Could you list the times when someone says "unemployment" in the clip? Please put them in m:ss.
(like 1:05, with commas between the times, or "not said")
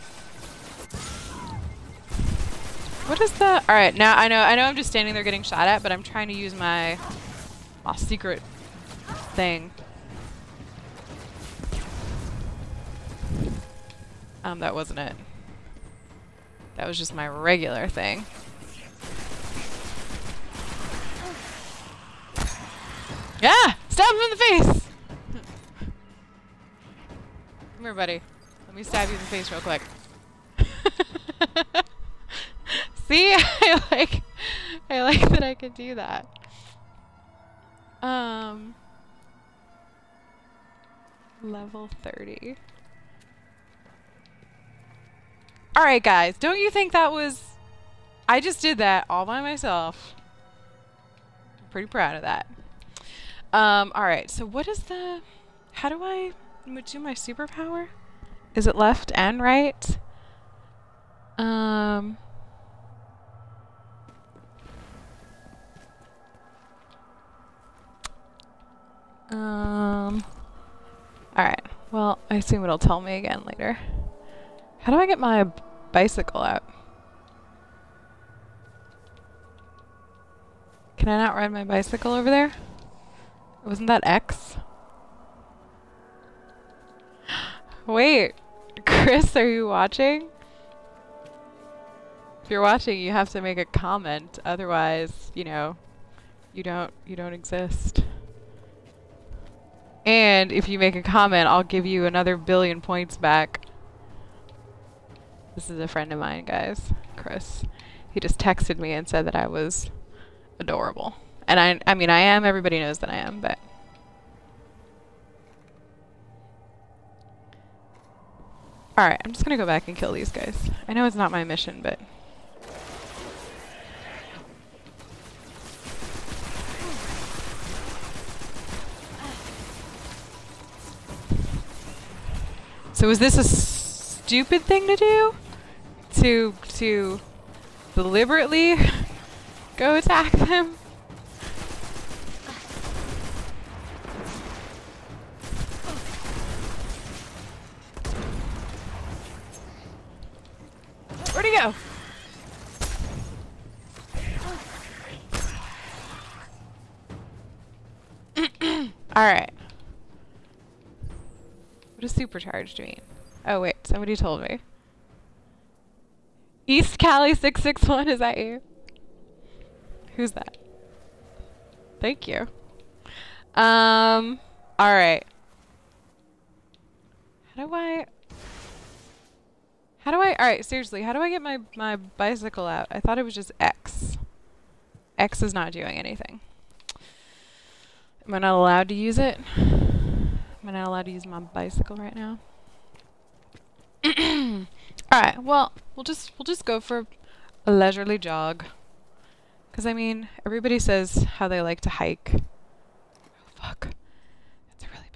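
not said.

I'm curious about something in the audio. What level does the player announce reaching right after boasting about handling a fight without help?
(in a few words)
30.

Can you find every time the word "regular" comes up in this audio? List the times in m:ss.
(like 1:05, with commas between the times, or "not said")
0:17.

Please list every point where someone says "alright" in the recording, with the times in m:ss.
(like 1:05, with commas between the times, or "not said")
0:53, 1:11, 1:58, 2:39, 2:54, 3:00, 3:15.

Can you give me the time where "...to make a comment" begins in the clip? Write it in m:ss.
1:33.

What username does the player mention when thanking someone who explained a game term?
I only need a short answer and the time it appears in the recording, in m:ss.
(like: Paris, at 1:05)
East Cali 661, at 2:46.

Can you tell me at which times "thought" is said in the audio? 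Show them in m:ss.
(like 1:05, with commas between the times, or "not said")
3:02.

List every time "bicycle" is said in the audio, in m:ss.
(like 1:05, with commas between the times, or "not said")
1:15, 1:21, 3:01, 3:11.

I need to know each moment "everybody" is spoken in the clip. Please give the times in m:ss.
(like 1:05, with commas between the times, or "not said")
1:52, 3:20.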